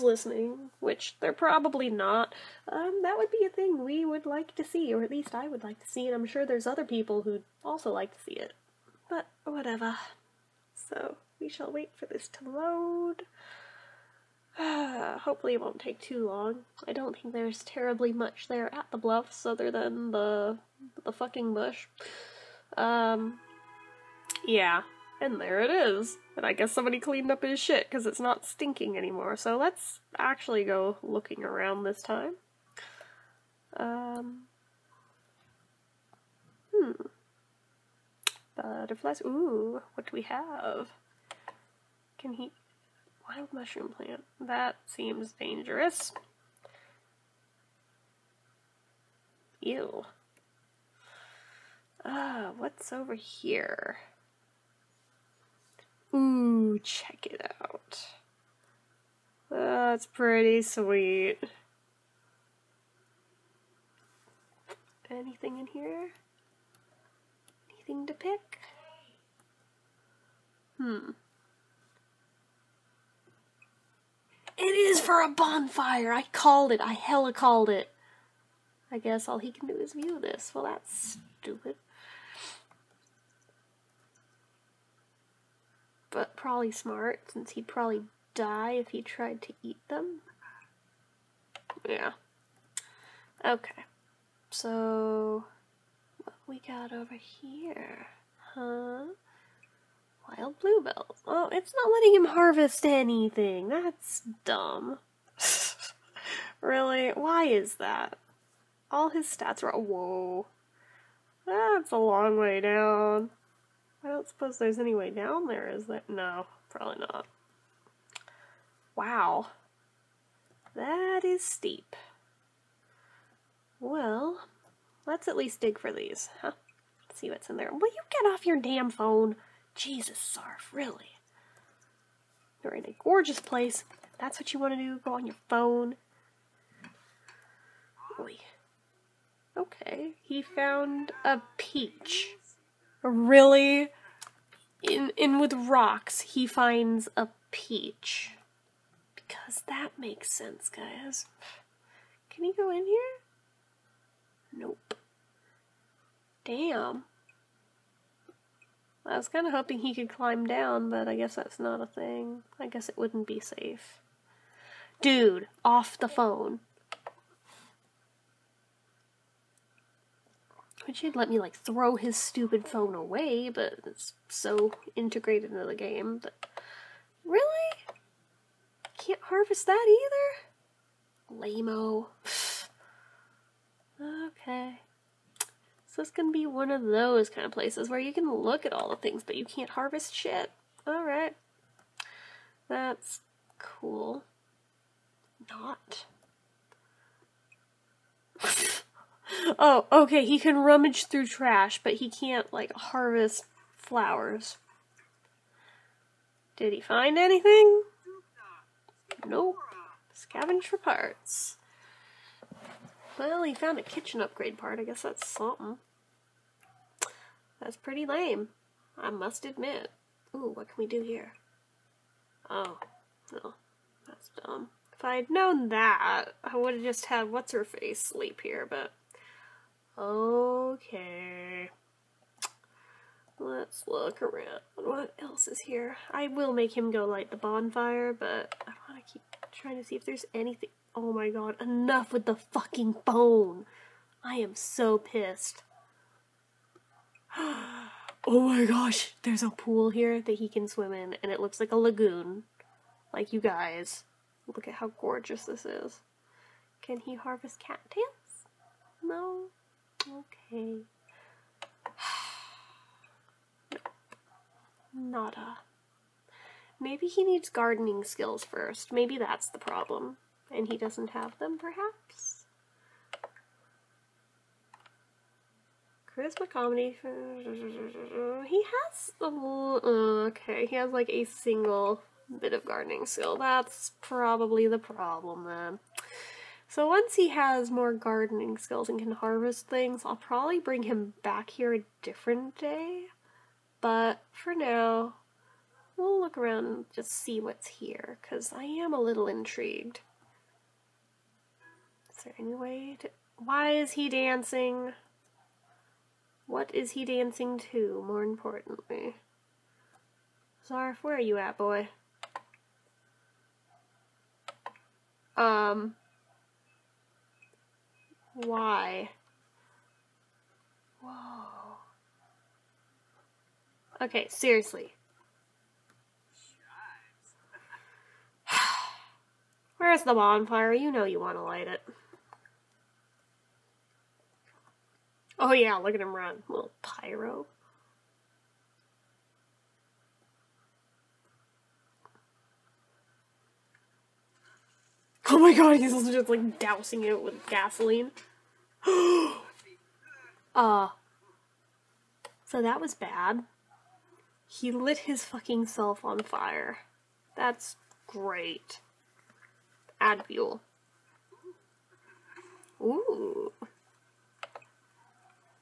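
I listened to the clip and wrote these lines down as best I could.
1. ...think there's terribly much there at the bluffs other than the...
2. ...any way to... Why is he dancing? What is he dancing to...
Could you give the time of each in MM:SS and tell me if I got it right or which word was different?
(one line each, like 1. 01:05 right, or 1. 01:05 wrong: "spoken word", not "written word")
1. 00:17 right
2. 05:02 right.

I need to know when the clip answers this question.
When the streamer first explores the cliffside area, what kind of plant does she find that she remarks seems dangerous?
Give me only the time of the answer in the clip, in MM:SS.
00:43.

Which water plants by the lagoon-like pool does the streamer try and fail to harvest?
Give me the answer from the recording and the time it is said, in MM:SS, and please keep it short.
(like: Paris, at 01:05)
Cattails, at 04:17.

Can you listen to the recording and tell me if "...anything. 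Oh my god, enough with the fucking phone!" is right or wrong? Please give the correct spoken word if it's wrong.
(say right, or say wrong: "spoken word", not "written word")
right.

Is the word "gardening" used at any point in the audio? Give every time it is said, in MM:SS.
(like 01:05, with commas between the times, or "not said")
04:27, 04:42, 04:47.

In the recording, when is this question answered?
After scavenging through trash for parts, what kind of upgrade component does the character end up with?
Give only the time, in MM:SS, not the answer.
03:33.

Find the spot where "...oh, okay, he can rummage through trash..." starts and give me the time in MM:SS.
03:19.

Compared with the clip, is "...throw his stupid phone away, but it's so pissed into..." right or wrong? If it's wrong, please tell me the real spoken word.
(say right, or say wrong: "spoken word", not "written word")
wrong: "integrated", not "pissed".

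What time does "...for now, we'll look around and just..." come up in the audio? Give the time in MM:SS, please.
04:54.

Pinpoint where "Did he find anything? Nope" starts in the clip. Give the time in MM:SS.
03:26.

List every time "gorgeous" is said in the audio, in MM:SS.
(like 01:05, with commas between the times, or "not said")
02:13, 04:15.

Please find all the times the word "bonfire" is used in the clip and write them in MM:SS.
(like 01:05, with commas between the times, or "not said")
01:15, 03:57, 05:30.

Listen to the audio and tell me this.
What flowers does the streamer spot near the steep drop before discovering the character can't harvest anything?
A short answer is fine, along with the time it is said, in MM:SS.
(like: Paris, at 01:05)
Wild bluebells, at 01:40.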